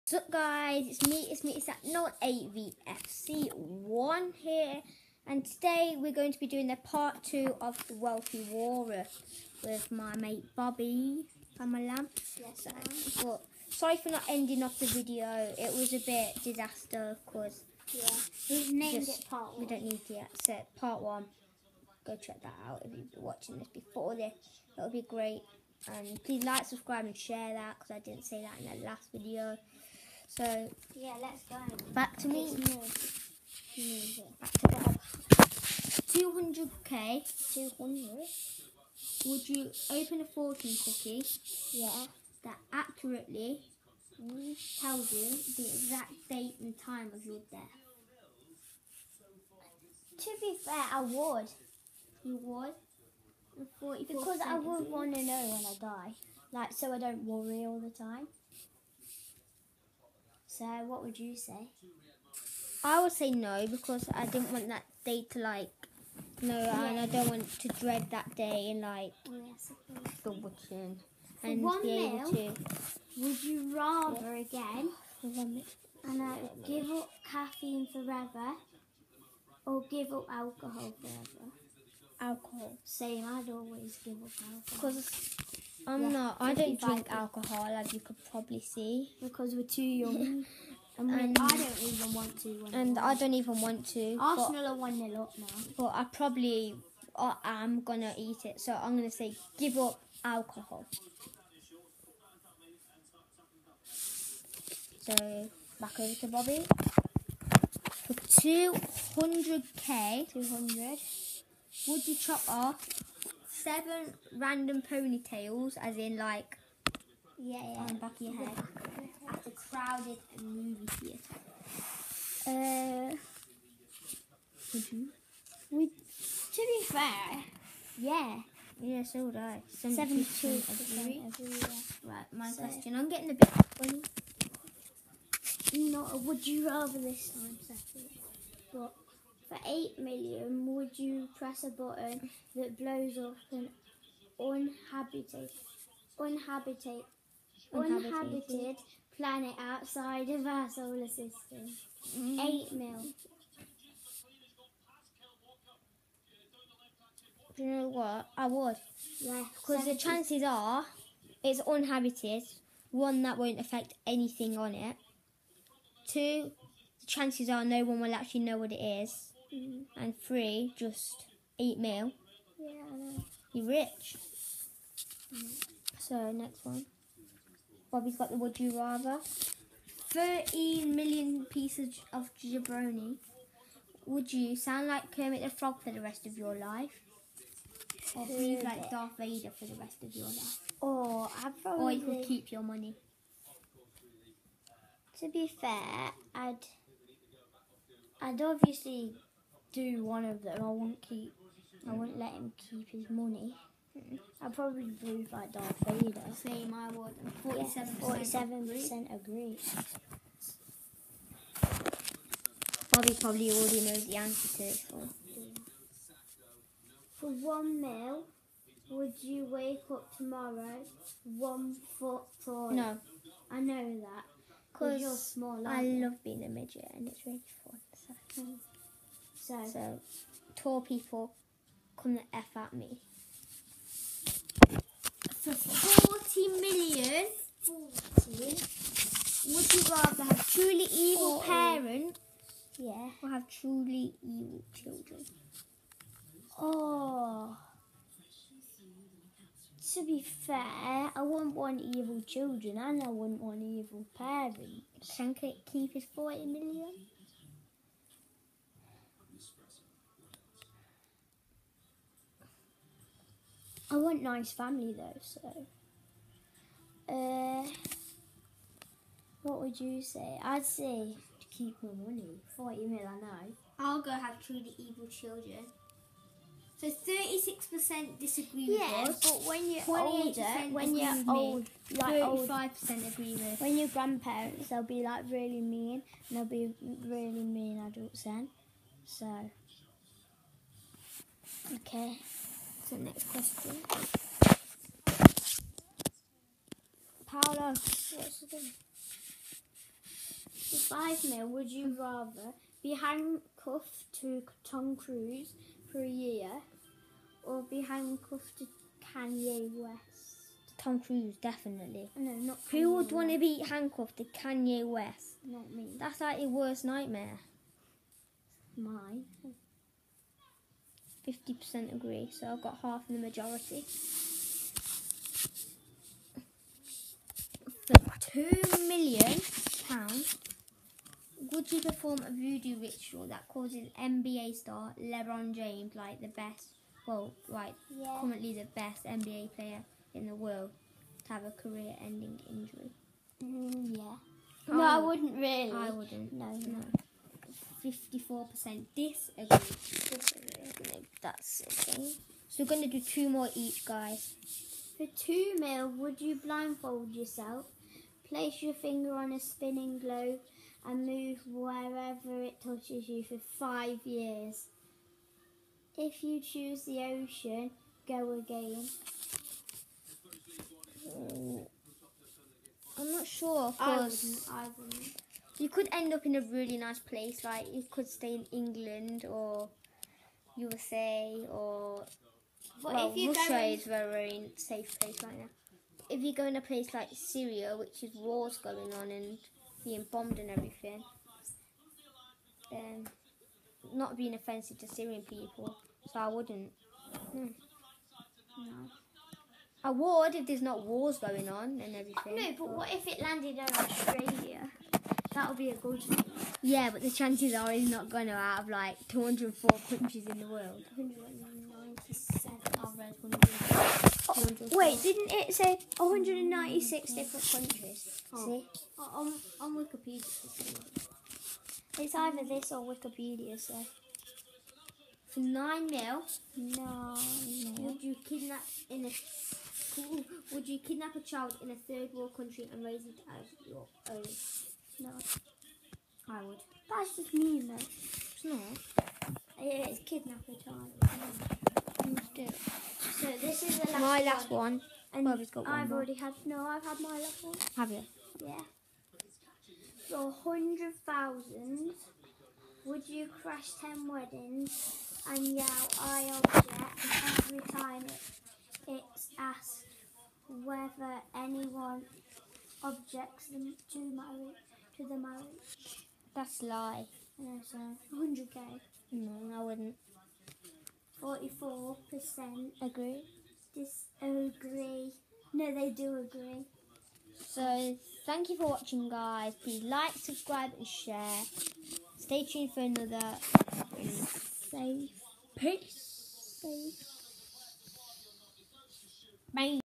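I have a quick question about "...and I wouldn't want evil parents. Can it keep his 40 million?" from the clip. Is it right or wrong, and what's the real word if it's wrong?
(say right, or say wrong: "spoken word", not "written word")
right.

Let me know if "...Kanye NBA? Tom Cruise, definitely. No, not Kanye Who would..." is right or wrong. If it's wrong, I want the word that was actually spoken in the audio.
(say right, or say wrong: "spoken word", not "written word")
wrong: "West", not "NBA".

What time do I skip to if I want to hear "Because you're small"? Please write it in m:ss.
3:44.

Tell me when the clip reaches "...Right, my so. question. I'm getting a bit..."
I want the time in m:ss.
2:12.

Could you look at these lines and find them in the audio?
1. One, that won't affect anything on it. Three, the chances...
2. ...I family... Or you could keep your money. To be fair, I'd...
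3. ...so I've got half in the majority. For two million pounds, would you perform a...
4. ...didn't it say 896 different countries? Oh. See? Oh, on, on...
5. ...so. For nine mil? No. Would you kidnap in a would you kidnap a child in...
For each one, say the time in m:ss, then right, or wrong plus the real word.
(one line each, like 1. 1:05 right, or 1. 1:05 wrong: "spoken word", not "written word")
1. 2:42 wrong: "Two", not "Three"
2. 3:11 wrong: "probably", not "family"
3. 5:22 right
4. 6:55 wrong: "196", not "896"
5. 7:03 right.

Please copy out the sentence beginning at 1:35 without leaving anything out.
But I probably I am going to eat it.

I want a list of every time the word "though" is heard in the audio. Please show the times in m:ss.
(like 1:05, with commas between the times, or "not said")
4:24, 7:17.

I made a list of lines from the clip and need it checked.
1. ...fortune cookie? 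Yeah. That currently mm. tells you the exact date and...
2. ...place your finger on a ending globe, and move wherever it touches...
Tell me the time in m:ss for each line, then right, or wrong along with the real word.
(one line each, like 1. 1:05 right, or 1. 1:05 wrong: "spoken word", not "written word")
1. 0:40 wrong: "accurately", not "currently"
2. 5:58 wrong: "spinning", not "ending".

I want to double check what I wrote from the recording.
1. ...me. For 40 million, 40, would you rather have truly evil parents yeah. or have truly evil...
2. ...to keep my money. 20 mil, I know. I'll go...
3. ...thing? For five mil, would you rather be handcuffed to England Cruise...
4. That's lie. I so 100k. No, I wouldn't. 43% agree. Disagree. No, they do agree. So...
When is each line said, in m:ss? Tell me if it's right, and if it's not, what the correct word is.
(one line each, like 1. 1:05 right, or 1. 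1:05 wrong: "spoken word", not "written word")
1. 3:52 right
2. 4:31 wrong: "40", not "20"
3. 4:58 wrong: "Tom", not "England"
4. 7:46 wrong: "44", not "43".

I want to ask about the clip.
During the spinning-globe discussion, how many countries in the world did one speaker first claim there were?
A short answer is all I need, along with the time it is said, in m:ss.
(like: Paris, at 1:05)
204, at 6:49.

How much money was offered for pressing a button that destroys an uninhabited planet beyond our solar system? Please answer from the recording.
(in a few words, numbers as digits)
8 million.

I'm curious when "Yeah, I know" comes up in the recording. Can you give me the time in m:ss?
2:52.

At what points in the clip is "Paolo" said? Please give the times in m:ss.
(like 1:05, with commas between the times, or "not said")
4:57.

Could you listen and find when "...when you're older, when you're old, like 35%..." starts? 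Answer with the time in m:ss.
4:39.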